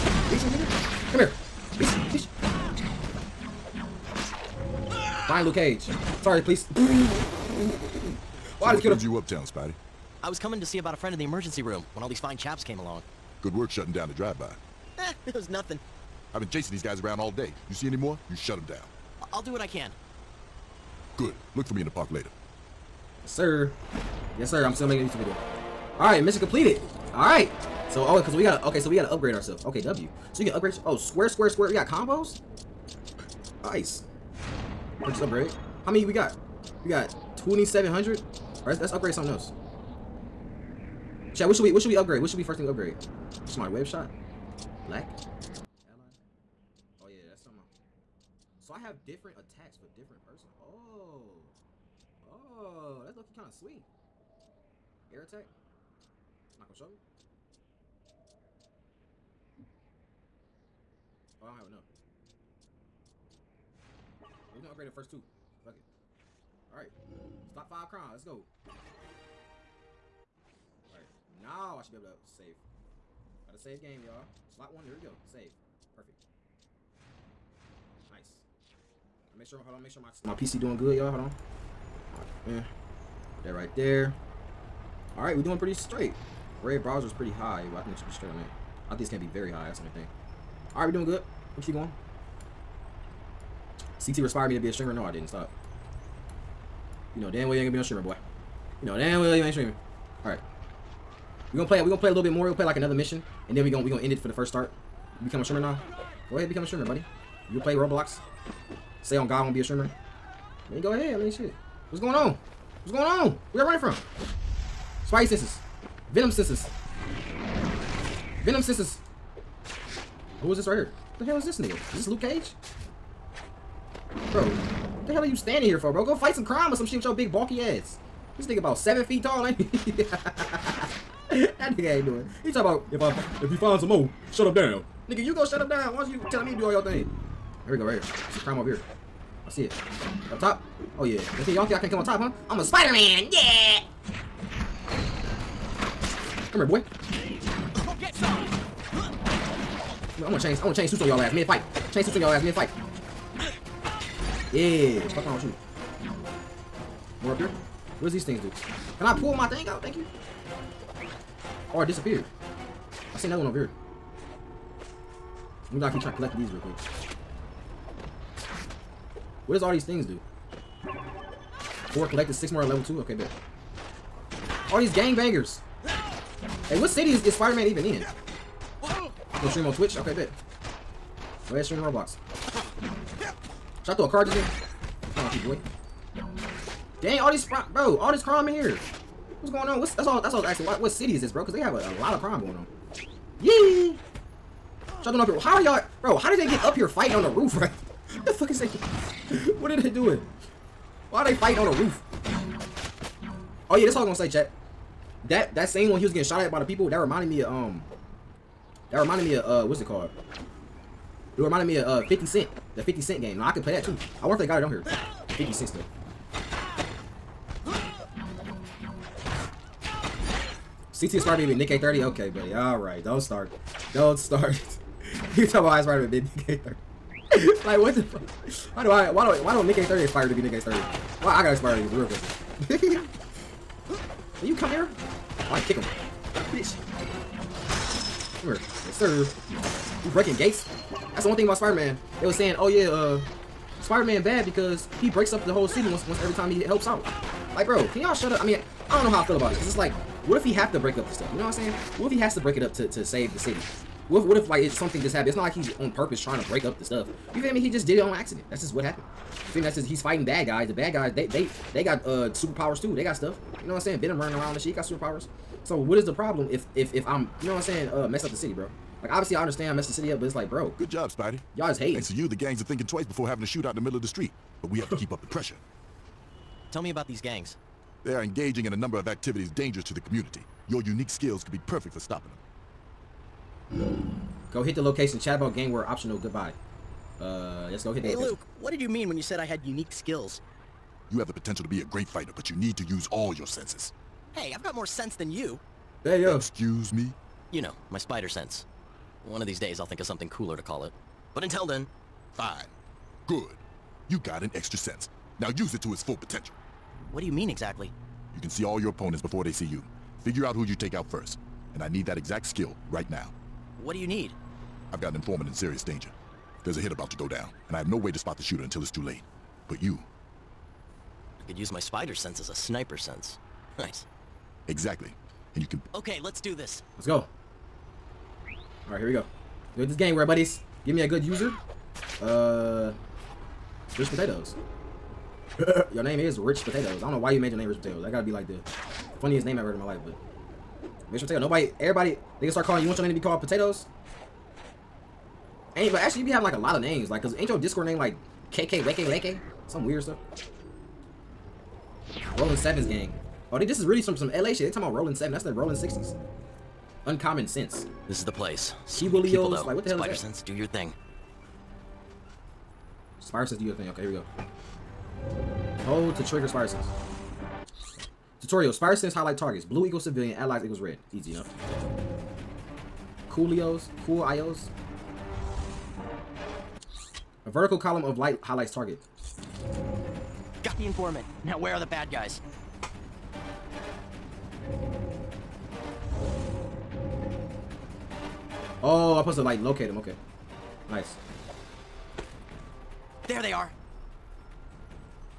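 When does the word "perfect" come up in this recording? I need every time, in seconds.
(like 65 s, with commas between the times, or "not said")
75 s, 281 s.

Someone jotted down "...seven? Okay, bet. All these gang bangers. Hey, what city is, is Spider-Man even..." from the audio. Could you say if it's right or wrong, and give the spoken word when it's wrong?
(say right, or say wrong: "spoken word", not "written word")
wrong: "two", not "seven".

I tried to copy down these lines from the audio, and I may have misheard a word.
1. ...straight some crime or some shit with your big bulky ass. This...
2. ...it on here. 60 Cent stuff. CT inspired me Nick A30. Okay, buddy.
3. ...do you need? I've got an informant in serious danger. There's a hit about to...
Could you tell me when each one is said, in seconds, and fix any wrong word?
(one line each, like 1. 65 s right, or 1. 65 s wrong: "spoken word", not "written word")
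1. 126 s wrong: "fight", not "straight"
2. 214 s wrong: "50", not "60"
3. 313 s right.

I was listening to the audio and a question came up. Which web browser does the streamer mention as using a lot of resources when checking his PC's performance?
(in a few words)
Brave.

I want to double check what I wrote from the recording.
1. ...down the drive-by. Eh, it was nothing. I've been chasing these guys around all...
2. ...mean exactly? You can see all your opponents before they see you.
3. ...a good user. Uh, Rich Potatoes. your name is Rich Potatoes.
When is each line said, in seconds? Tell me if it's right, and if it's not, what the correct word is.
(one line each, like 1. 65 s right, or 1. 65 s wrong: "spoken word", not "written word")
1. 13 s right
2. 307 s right
3. 331 s right.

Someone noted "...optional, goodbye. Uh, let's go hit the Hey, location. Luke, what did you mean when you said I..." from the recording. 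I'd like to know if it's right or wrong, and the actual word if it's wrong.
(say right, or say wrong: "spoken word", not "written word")
right.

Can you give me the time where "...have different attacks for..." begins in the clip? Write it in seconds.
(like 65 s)
48 s.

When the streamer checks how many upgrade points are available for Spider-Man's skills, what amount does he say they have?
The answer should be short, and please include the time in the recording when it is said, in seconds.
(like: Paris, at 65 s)
2,700, at 37 s.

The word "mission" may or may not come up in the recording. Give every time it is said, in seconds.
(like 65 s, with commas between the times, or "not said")
26 s, 102 s.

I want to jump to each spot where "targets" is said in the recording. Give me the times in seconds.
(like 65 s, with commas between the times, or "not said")
369 s, 378 s.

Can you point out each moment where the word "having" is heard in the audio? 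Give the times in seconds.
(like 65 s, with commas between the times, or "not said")
273 s, 346 s.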